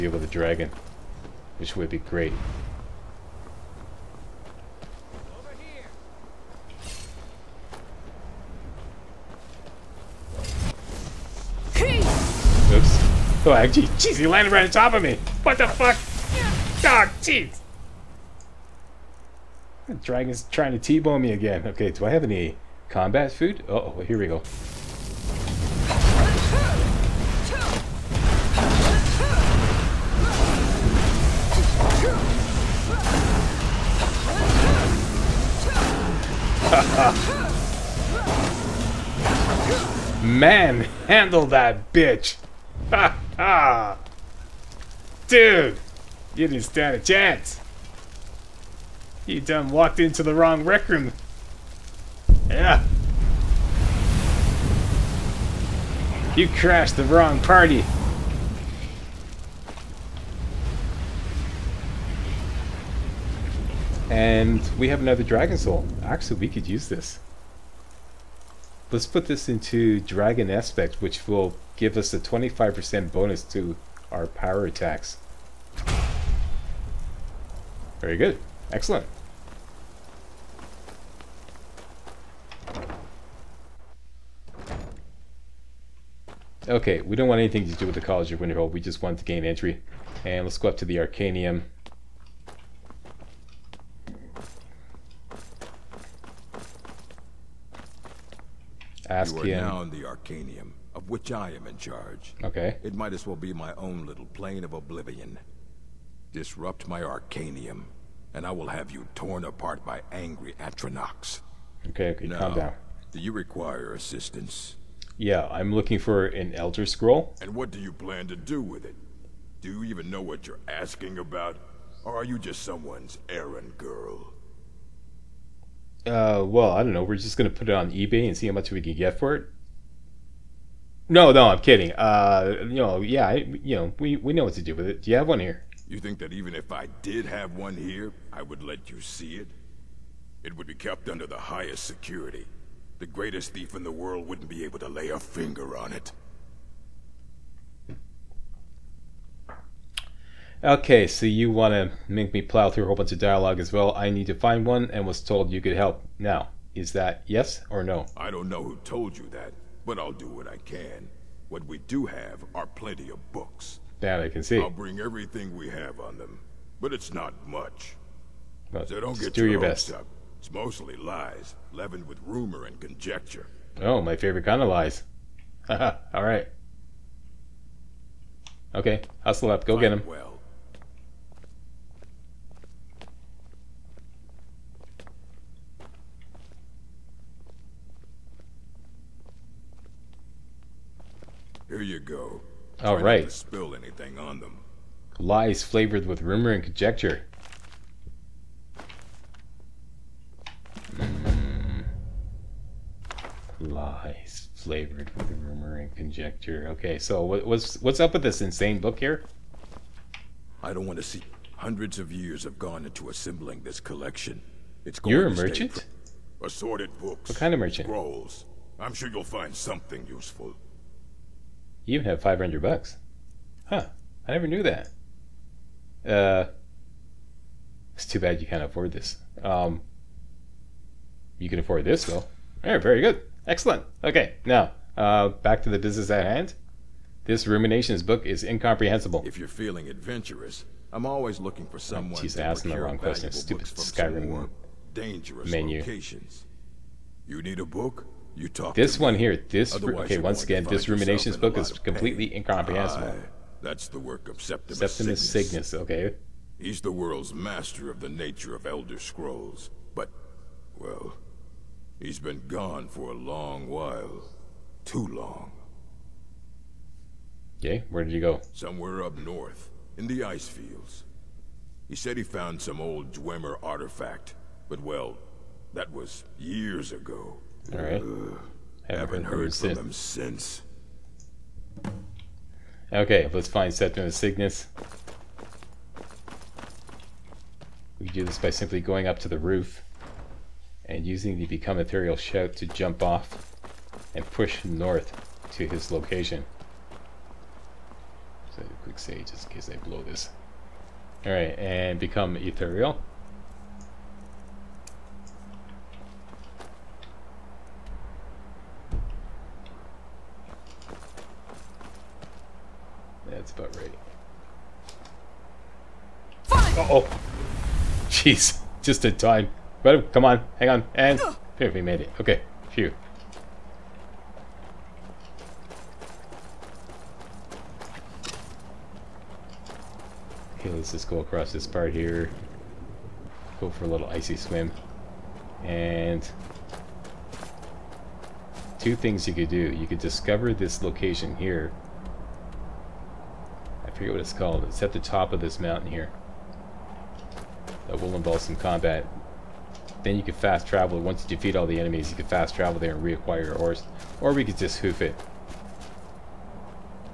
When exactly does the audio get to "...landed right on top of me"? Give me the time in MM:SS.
00:14.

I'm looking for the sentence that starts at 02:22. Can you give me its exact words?
The greatest thief in the world wouldn't be able to lay a finger on it.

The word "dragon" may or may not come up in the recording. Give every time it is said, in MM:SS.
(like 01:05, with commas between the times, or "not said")
00:00, 00:20, 01:05, 01:10.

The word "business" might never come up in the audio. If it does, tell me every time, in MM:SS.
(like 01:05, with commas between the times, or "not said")
03:55.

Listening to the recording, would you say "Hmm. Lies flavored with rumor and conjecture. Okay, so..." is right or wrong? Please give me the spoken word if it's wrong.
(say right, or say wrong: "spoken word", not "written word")
right.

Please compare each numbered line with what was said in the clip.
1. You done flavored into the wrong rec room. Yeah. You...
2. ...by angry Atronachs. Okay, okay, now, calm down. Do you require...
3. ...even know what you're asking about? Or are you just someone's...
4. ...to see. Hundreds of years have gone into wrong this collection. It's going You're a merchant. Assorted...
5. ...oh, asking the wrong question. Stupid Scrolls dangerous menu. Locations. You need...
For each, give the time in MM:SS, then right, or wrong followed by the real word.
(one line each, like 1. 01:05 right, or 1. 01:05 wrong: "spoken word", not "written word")
1. 00:49 wrong: "walked", not "flavored"
2. 01:49 right
3. 01:59 right
4. 03:30 wrong: "assembling", not "wrong"
5. 04:02 wrong: "Skyrim", not "Scrolls".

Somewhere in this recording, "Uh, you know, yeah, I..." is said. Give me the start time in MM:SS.
02:11.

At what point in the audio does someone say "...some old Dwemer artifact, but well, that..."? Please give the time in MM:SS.
04:32.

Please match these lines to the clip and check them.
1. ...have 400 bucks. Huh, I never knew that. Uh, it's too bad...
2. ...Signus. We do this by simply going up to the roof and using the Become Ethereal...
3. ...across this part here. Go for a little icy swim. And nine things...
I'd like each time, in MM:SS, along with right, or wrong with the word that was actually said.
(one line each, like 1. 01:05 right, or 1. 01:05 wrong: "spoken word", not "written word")
1. 03:42 wrong: "500", not "400"
2. 04:44 right
3. 05:31 wrong: "two", not "nine".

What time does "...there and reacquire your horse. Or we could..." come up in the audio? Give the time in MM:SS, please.
05:52.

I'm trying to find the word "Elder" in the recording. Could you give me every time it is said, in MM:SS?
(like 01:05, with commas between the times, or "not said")
01:56, 04:18.